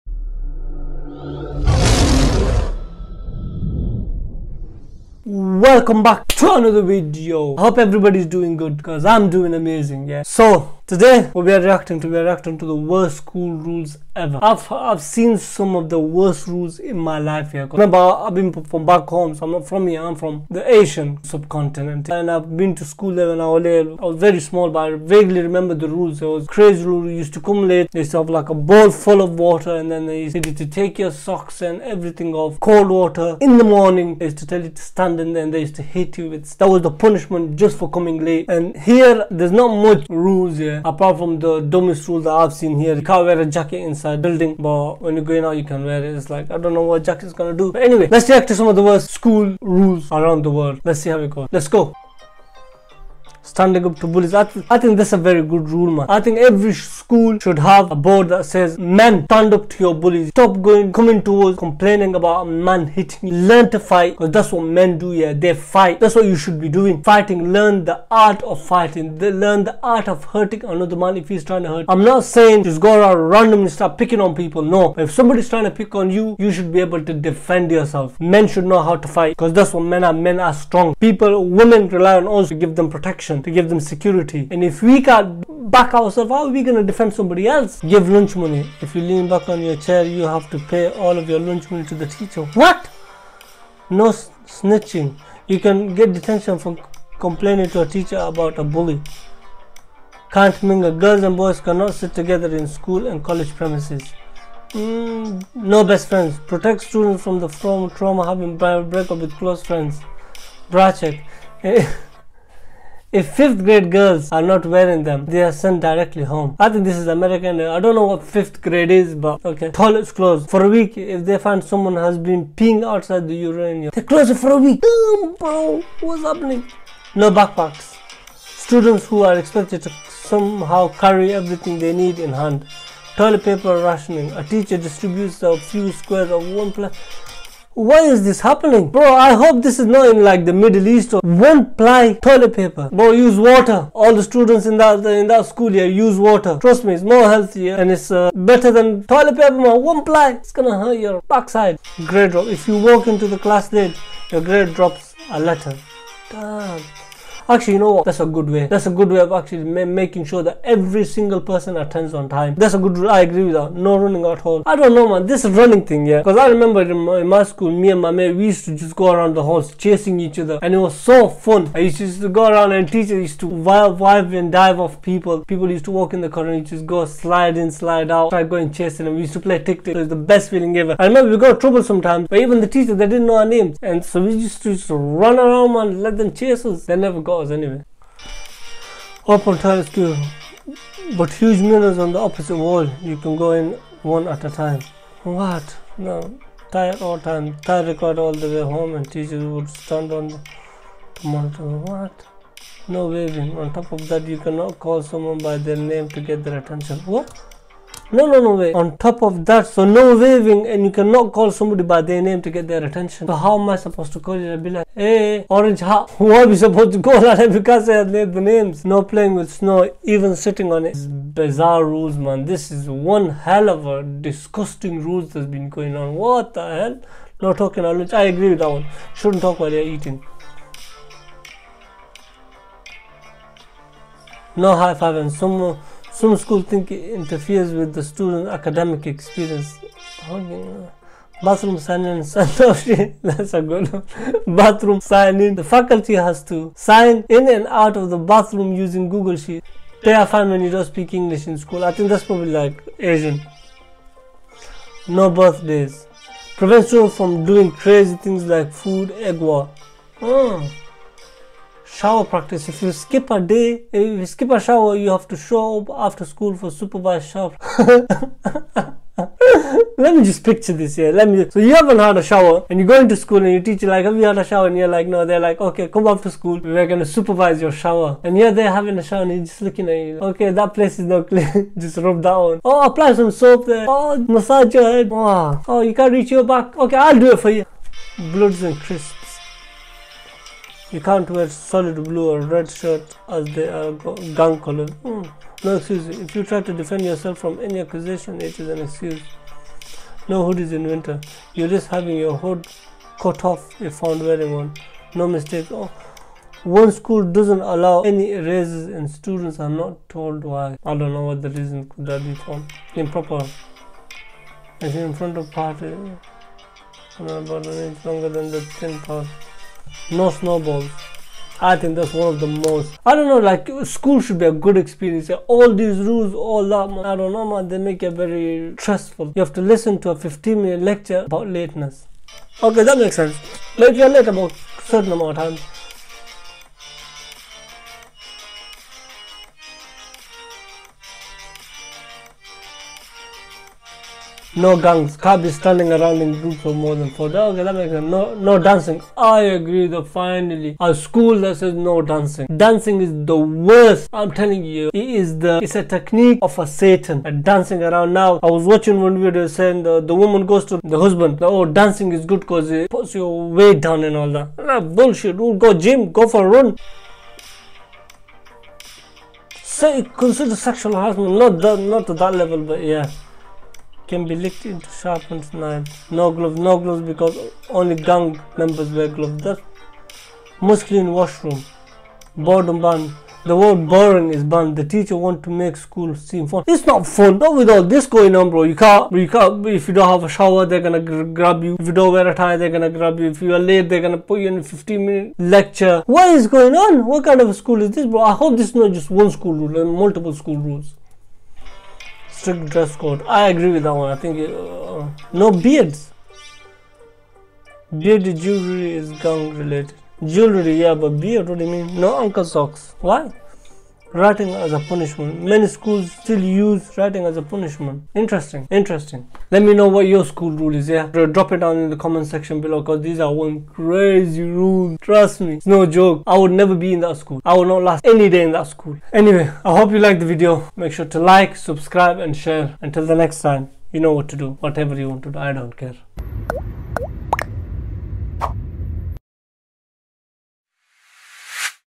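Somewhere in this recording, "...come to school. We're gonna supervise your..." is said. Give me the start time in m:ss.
4:35.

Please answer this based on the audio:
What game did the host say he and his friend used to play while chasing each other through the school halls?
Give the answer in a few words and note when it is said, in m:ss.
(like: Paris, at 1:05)
tic tac, at 2:59.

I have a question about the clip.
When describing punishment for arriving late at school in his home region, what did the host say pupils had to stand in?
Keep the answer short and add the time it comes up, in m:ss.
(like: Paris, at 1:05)
a bowl full of water, at 0:28.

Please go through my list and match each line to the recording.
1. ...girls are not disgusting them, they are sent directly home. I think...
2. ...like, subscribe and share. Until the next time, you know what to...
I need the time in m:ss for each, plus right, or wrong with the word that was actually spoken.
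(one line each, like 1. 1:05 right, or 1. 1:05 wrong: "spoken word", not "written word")
1. 1:53 wrong: "wearing", not "disgusting"
2. 7:11 right.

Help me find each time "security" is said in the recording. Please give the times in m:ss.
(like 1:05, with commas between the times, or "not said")
1:23.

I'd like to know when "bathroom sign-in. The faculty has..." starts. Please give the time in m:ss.
4:04.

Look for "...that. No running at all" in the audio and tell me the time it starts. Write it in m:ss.
2:43.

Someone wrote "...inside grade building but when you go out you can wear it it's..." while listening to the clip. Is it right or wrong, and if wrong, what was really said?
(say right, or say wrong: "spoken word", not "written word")
wrong: "inside", not "grade".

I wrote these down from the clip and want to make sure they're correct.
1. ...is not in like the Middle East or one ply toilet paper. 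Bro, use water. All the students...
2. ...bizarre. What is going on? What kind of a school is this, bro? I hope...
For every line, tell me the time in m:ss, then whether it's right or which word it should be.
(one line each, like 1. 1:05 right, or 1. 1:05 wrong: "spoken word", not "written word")
1. 2:19 right
2. 6:35 wrong: "lecture", not "bizarre".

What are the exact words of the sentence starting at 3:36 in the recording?
who are we supposed to call that?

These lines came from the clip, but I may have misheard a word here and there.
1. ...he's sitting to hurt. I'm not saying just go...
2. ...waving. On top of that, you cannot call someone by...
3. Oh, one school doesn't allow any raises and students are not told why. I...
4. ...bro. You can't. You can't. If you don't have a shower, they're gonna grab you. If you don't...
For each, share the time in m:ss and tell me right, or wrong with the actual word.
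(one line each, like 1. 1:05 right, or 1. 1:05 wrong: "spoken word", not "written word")
1. 1:11 wrong: "trying", not "sitting"
2. 3:23 right
3. 5:05 right
4. 6:28 right.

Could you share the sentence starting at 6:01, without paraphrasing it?
Oh, dancing is good because it puts your weight down and all that.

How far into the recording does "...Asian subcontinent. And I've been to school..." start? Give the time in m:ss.
0:20.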